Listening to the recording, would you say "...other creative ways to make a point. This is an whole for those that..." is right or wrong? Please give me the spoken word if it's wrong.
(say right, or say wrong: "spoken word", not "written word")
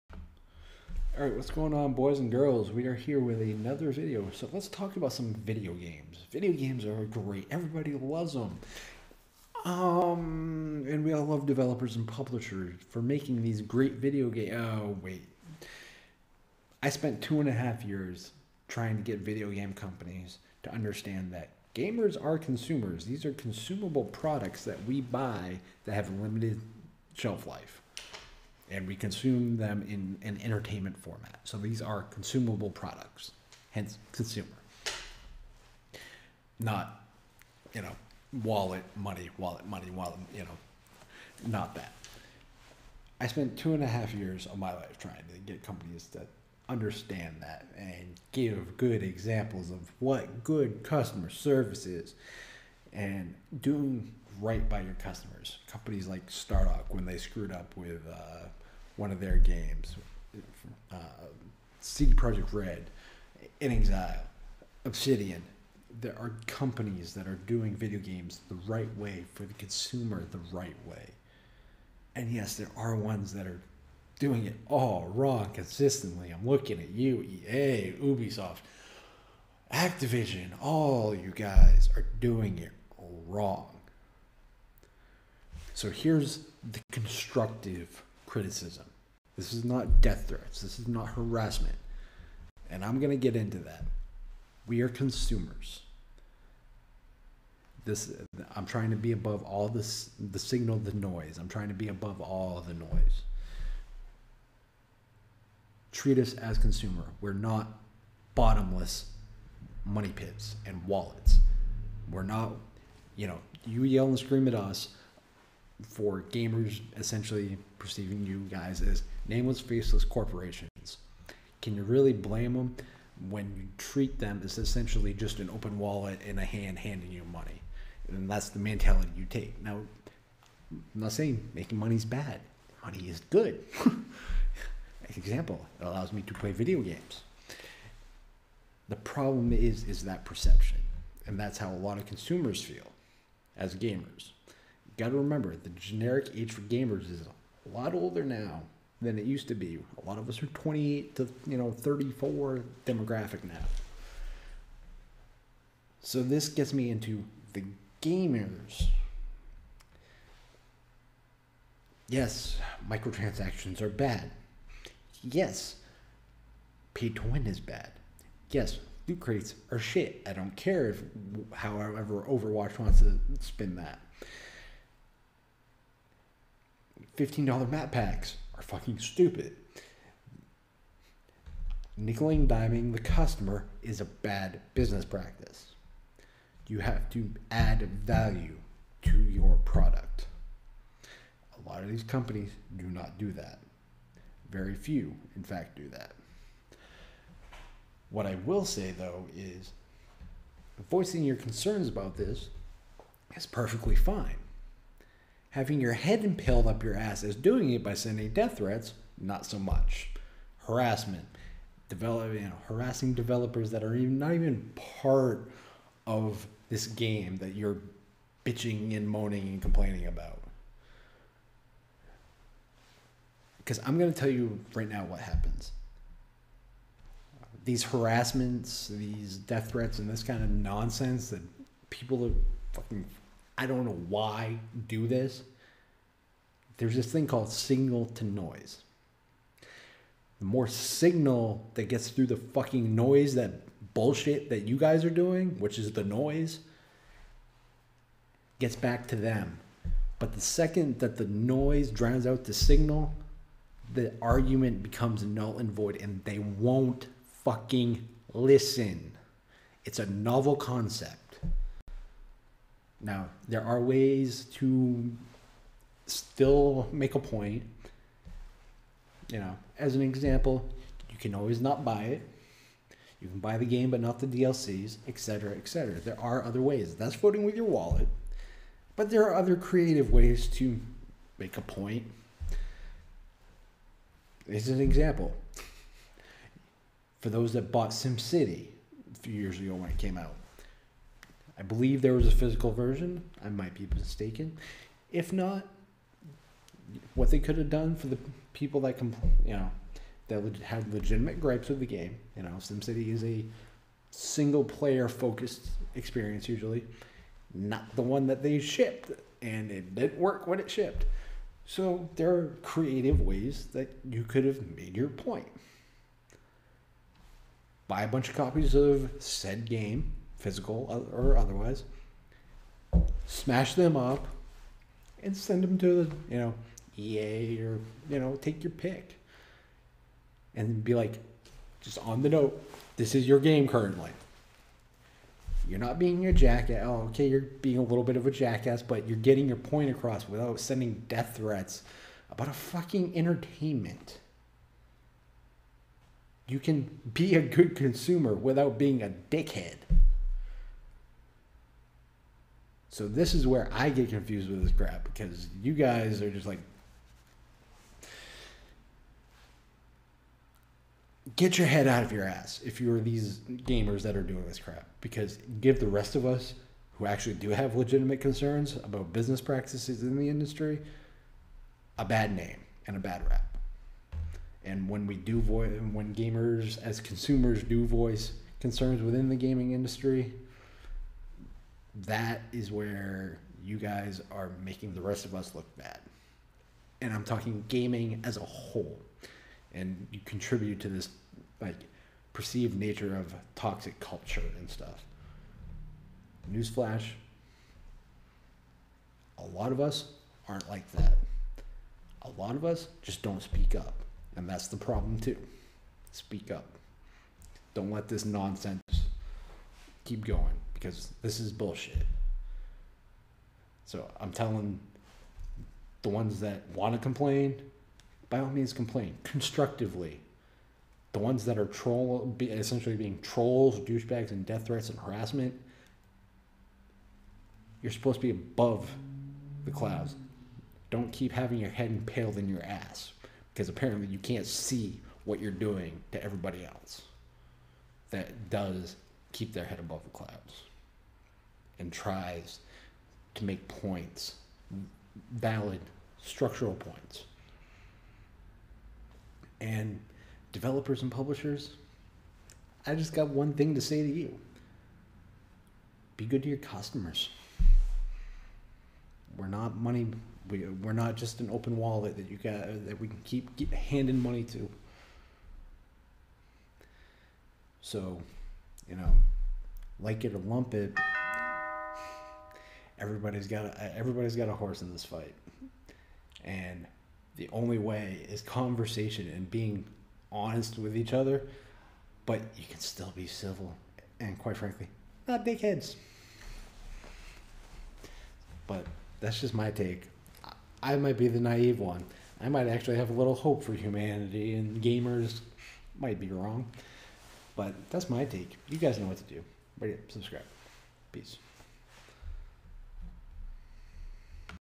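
wrong: "example", not "whole".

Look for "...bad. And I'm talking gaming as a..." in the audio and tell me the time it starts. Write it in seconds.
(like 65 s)
385 s.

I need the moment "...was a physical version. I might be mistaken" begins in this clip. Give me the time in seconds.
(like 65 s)
292 s.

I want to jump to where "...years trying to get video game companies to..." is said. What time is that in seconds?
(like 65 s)
17 s.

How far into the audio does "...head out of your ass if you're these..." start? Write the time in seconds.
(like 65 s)
361 s.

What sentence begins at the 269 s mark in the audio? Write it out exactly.
You know, as an example, you can always not buy it.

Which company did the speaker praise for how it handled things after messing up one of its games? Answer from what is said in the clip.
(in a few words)
Stardock.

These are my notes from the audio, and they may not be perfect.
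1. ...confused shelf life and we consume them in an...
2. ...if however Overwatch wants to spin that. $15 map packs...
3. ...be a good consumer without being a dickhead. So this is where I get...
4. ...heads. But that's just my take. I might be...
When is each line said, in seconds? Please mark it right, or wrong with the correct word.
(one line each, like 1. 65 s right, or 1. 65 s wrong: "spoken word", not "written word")
1. 26 s wrong: "limited", not "confused"
2. 170 s right
3. 347 s right
4. 485 s right.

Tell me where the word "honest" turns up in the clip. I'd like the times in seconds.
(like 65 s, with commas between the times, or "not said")
480 s.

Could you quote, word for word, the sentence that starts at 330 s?
And be like, just on the note, this is your game currently.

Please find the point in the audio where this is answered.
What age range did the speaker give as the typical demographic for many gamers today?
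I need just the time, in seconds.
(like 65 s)
150 s.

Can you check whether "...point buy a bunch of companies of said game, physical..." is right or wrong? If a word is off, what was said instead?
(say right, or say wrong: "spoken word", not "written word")
wrong: "copies", not "companies".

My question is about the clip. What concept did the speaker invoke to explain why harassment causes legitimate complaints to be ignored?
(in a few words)
signal to noise.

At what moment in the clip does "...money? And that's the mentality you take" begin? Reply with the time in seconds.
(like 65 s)
127 s.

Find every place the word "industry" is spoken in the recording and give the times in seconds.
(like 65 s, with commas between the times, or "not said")
370 s, 379 s.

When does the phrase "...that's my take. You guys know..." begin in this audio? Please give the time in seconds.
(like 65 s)
497 s.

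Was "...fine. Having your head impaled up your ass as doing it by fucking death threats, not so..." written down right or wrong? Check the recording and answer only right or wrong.
wrong.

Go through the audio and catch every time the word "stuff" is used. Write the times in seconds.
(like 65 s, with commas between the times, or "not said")
394 s.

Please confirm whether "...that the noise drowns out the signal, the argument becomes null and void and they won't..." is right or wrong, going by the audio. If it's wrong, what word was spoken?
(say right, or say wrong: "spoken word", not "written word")
right.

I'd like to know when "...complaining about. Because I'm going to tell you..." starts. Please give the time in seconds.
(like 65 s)
219 s.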